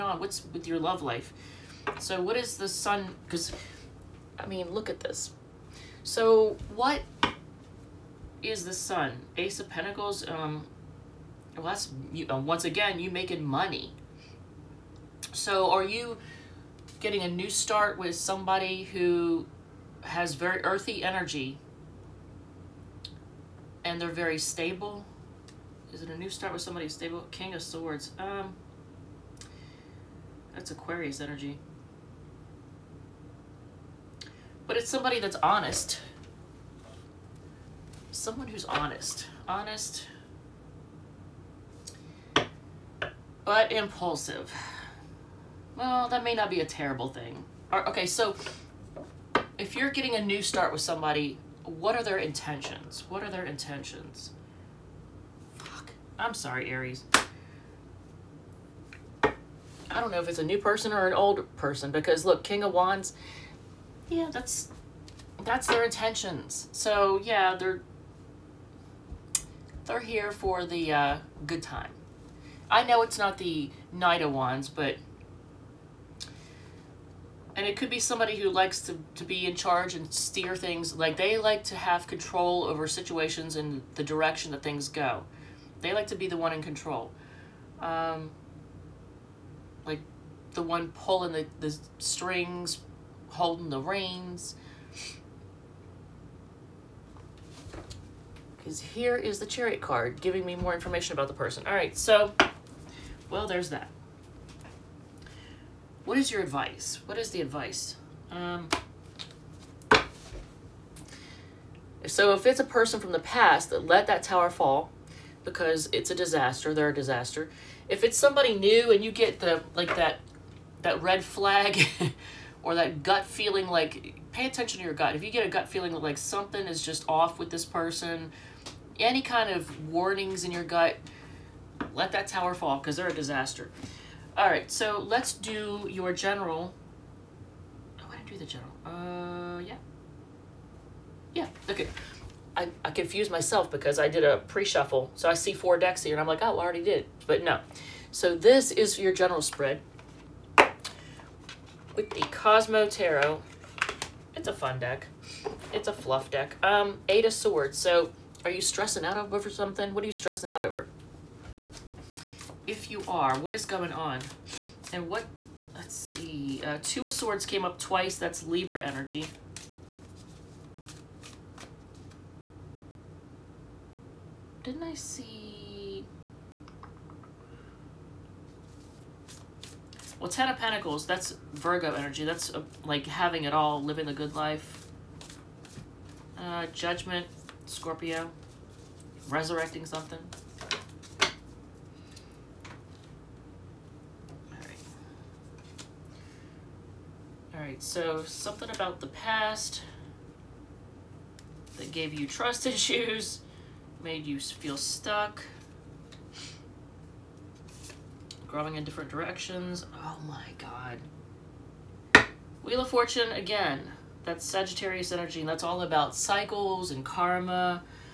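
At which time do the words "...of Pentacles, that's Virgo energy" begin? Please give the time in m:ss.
3:00.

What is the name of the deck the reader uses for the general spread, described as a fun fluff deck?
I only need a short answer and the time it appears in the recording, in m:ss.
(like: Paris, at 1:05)
Cosmo Tarot, at 2:32.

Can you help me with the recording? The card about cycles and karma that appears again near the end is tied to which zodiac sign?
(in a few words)
Sagittarius.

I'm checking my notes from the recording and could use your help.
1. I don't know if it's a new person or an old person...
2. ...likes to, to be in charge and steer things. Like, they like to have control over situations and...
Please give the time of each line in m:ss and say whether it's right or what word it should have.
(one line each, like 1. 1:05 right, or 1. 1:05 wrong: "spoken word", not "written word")
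1. 0:59 right
2. 1:18 right.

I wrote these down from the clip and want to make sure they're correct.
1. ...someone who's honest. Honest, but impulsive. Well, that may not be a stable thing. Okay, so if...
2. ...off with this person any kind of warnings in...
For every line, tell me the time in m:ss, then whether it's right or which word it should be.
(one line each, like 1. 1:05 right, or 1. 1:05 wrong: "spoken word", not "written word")
1. 0:38 wrong: "terrible", not "stable"
2. 2:07 right.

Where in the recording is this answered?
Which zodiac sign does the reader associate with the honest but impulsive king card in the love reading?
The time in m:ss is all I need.
0:30.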